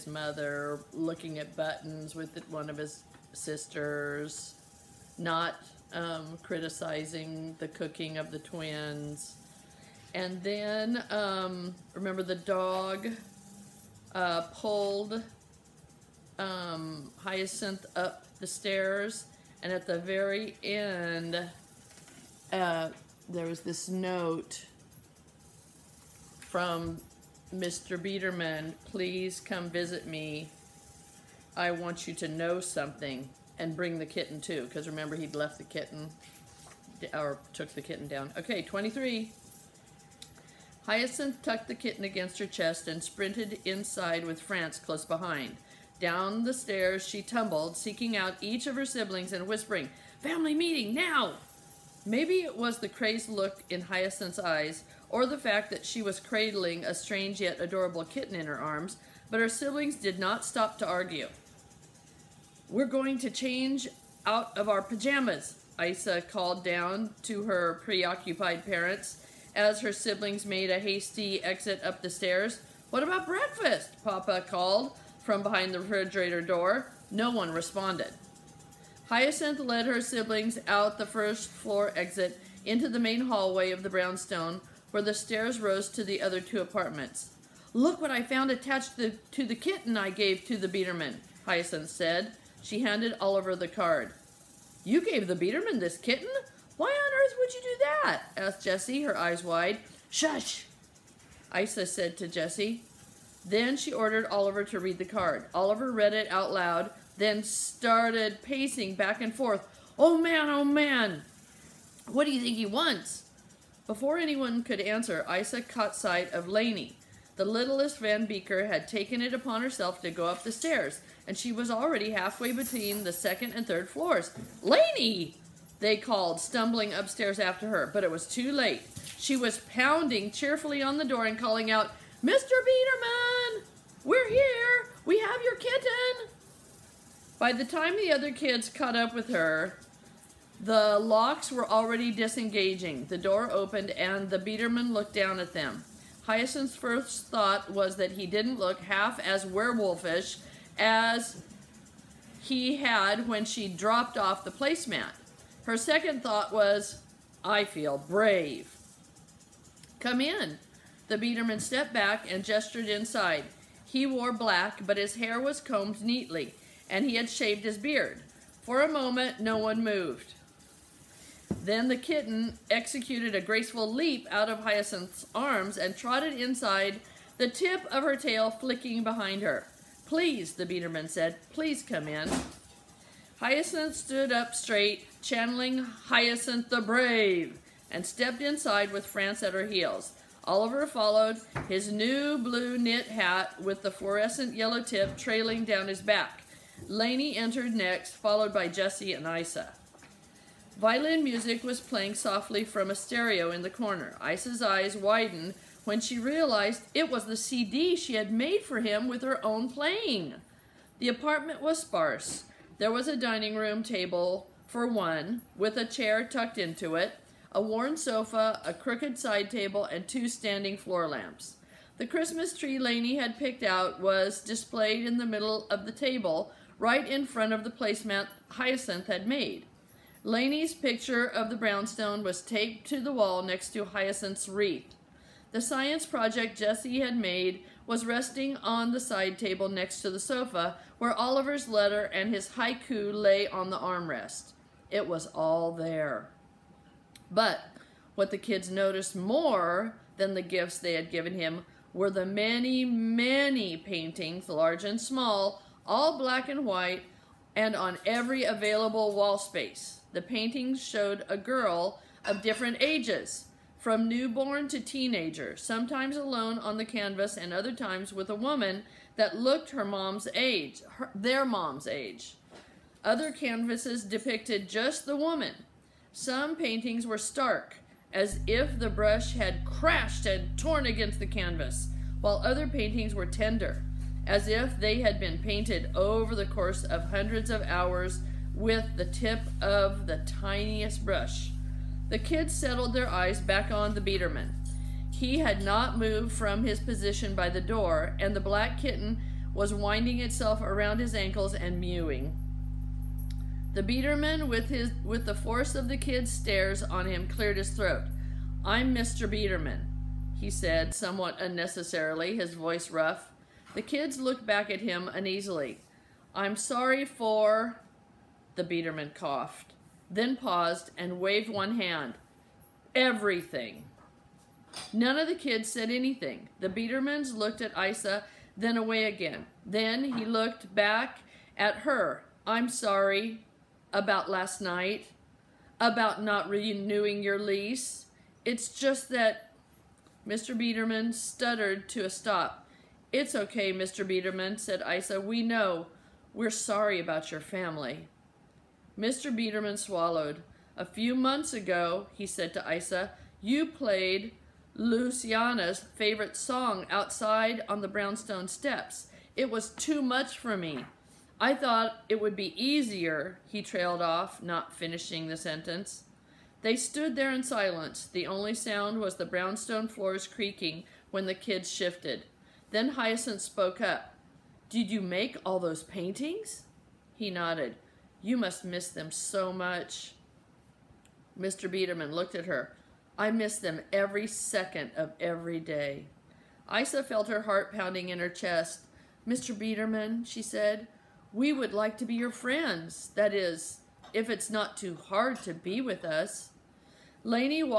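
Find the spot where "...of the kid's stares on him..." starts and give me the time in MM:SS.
05:05.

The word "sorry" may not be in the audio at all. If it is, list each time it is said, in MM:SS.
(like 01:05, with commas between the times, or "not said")
05:16, 05:32, 05:46.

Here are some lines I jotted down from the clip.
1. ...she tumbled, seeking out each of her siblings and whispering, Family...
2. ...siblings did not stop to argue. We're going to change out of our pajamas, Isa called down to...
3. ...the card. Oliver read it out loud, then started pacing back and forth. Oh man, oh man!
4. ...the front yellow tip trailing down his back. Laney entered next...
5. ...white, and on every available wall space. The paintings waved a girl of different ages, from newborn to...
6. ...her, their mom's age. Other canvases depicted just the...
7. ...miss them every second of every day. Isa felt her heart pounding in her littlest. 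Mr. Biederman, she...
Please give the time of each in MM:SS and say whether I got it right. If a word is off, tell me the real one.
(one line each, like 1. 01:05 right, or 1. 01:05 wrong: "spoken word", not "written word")
1. 00:47 right
2. 00:59 right
3. 01:44 right
4. 03:13 wrong: "fluorescent", not "front"
5. 04:16 wrong: "showed", not "waved"
6. 04:30 right
7. 06:23 wrong: "chest", not "littlest".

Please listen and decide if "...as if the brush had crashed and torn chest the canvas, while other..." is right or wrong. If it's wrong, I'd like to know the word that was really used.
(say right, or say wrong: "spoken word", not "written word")
wrong: "against", not "chest".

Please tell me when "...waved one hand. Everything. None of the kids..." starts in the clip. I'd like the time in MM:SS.
05:21.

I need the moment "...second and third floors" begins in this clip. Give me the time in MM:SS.
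02:03.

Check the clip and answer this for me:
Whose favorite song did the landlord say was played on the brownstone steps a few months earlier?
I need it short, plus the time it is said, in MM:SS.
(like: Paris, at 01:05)
Luciana's, at 05:54.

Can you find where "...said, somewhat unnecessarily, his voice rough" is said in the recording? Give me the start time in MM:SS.
05:10.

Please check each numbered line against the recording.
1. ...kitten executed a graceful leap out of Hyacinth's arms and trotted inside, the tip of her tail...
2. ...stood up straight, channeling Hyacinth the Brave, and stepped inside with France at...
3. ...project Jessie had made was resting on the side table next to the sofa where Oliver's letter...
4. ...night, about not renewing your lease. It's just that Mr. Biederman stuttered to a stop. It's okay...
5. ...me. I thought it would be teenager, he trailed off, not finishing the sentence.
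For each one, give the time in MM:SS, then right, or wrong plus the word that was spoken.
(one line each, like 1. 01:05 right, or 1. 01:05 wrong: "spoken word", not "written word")
1. 02:51 right
2. 03:03 right
3. 03:56 right
4. 05:34 right
5. 06:00 wrong: "easier", not "teenager".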